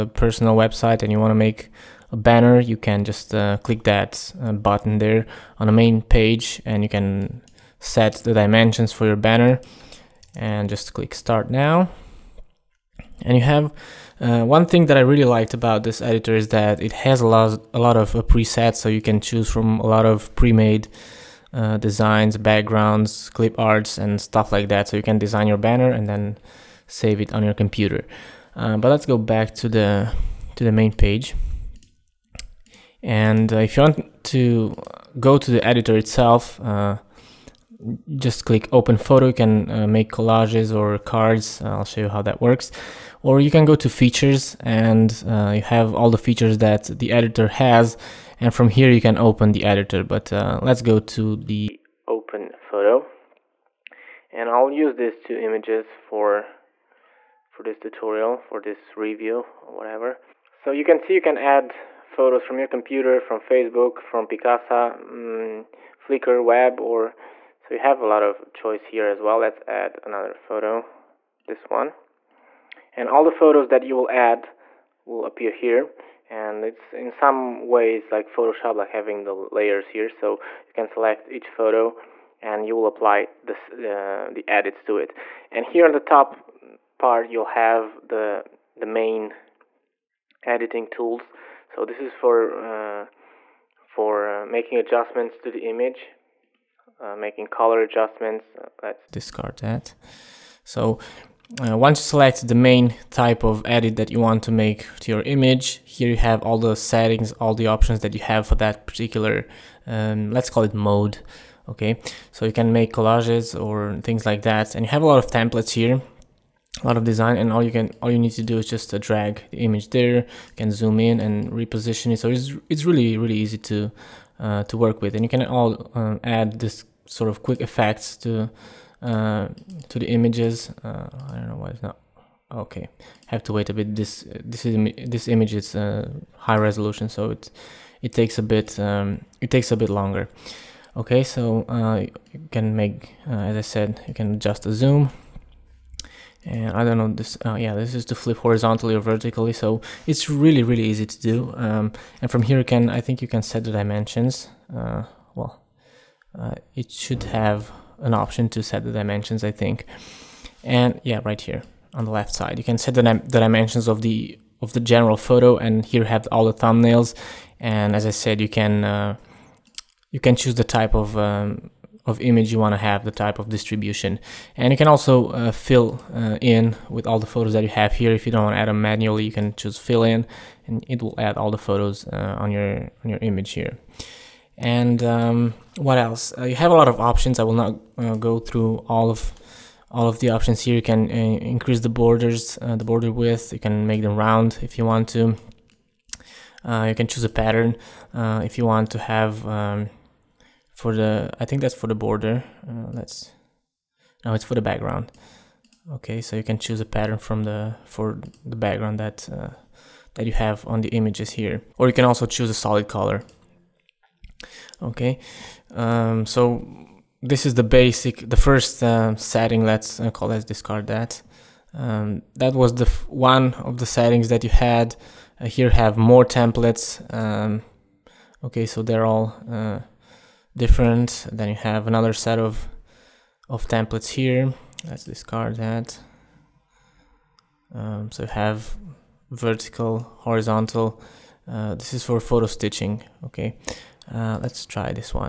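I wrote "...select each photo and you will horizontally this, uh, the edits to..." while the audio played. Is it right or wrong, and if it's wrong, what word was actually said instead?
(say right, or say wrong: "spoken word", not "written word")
wrong: "apply", not "horizontally".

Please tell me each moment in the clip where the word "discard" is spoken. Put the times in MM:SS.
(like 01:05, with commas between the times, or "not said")
01:39, 03:40, 03:55.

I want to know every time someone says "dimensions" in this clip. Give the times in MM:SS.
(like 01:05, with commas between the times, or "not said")
00:08, 02:33, 02:38, 02:43.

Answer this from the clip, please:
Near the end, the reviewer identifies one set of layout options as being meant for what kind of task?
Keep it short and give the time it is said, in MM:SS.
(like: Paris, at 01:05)
Photo stitching, at 04:02.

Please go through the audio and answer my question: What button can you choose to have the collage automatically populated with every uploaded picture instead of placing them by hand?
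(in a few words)
Fill in.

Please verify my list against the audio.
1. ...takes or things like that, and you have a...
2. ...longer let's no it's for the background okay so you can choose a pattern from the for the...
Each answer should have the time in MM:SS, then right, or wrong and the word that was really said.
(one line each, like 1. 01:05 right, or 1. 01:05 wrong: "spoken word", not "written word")
1. 01:52 wrong: "collages", not "takes"
2. 03:21 wrong: "border", not "longer".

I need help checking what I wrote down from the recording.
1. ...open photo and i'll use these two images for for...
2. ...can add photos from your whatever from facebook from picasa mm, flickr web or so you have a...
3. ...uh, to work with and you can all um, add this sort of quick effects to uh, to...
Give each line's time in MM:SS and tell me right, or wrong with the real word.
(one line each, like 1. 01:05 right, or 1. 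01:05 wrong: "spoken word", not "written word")
1. 00:52 right
2. 01:01 wrong: "computer", not "whatever"
3. 02:04 right.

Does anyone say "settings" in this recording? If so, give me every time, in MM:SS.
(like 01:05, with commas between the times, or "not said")
01:46, 03:39, 03:43.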